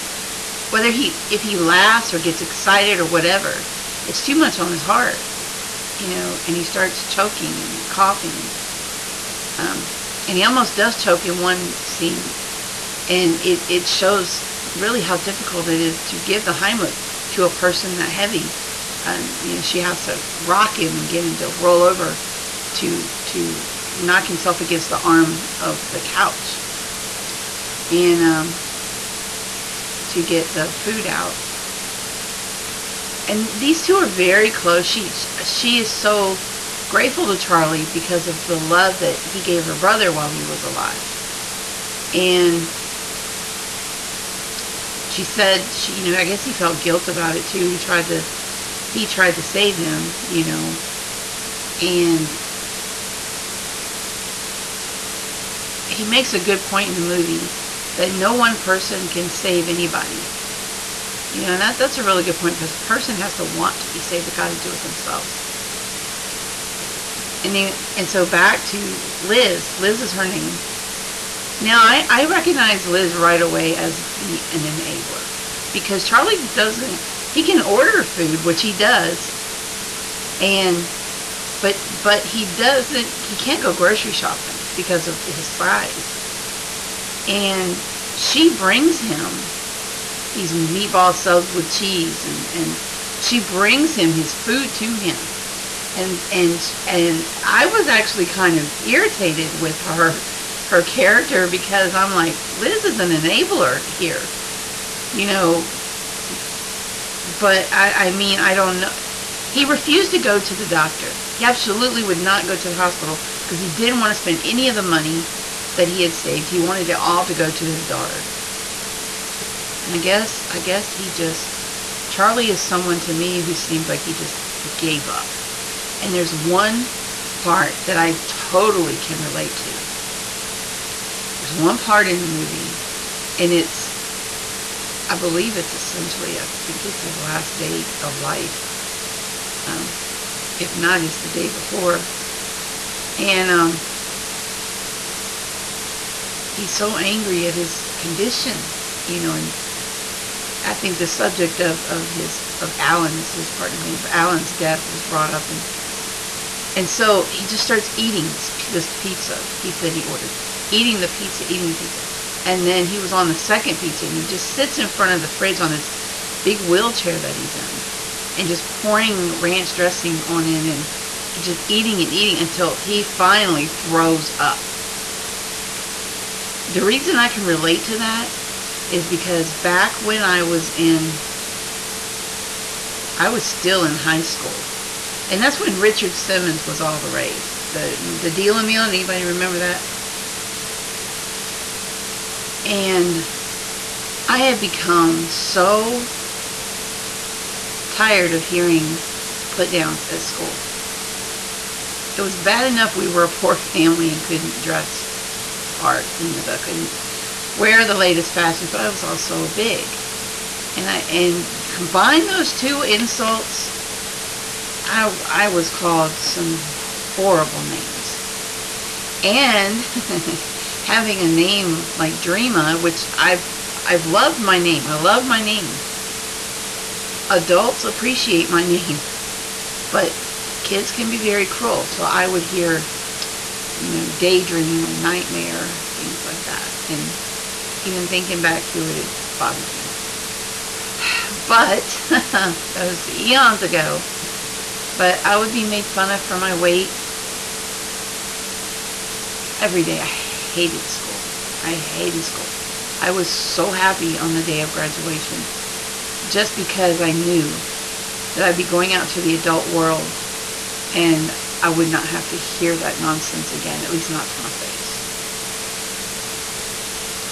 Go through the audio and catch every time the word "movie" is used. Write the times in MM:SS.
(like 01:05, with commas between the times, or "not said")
00:57, 02:12.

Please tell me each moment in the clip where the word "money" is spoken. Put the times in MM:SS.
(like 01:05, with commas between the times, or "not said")
01:54.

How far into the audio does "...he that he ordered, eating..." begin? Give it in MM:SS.
02:39.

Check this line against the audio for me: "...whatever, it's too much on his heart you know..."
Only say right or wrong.
right.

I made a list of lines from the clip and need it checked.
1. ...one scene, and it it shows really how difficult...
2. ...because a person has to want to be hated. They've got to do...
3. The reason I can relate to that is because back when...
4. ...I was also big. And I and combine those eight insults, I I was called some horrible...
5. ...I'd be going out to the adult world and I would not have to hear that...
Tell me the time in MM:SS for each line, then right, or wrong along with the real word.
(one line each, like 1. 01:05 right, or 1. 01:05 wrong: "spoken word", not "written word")
1. 00:11 right
2. 01:02 wrong: "saved", not "hated"
3. 02:56 right
4. 03:28 wrong: "two", not "eight"
5. 04:18 right.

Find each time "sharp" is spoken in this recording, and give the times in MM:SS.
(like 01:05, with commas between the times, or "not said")
not said.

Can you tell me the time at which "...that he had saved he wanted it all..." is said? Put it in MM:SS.
01:55.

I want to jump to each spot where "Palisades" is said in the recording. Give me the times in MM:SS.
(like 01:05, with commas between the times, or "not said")
not said.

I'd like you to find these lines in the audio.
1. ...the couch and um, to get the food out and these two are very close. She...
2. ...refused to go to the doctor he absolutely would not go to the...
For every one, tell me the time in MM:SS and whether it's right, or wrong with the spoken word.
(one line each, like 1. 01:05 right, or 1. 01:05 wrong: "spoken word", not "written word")
1. 00:25 right
2. 01:49 right.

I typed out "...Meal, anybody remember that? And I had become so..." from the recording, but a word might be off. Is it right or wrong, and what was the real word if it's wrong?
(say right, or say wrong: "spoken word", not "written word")
right.